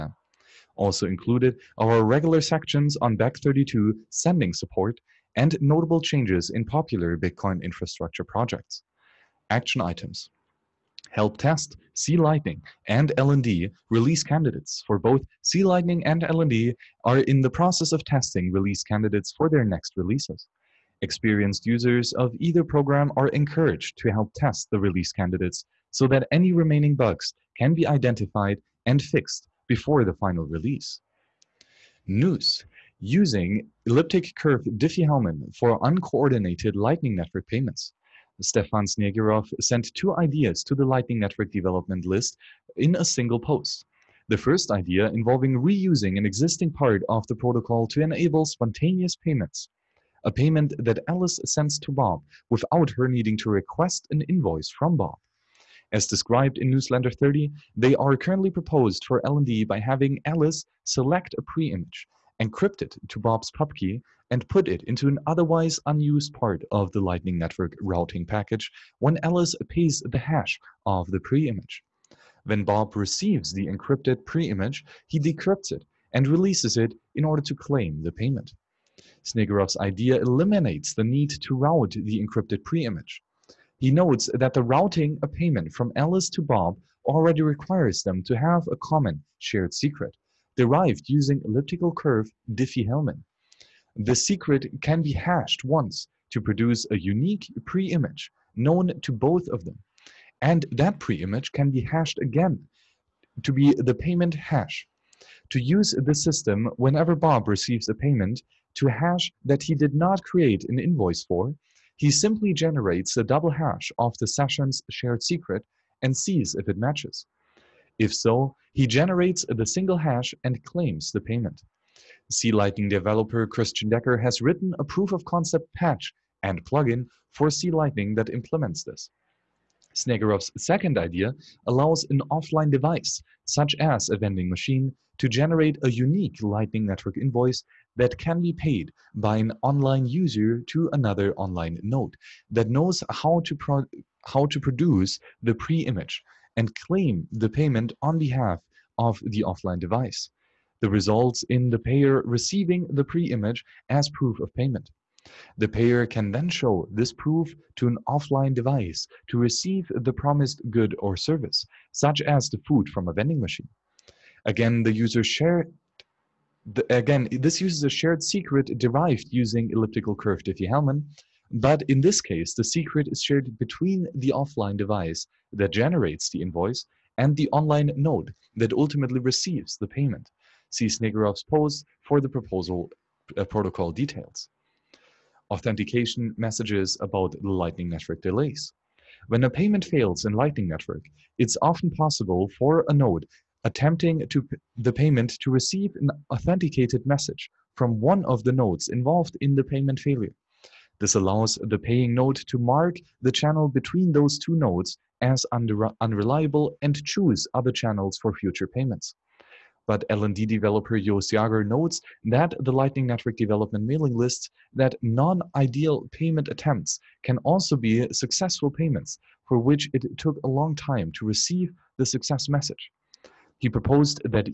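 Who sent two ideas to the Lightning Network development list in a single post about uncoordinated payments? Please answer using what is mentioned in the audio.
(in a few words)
Stepan Snigirev.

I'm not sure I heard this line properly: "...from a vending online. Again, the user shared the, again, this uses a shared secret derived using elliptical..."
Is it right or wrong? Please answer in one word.
wrong.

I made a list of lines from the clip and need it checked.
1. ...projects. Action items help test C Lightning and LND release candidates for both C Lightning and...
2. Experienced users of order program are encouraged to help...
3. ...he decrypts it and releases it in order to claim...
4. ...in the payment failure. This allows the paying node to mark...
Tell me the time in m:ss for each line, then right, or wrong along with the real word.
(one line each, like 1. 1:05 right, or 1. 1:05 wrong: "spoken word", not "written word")
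1. 0:08 right
2. 0:21 wrong: "either", not "order"
3. 1:15 right
4. 3:19 right.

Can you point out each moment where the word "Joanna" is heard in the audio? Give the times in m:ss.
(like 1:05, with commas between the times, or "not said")
not said.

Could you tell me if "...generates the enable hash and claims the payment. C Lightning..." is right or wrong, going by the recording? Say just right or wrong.
wrong.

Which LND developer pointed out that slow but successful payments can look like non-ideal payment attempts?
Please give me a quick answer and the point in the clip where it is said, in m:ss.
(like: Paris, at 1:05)
Joost Jager, at 3:30.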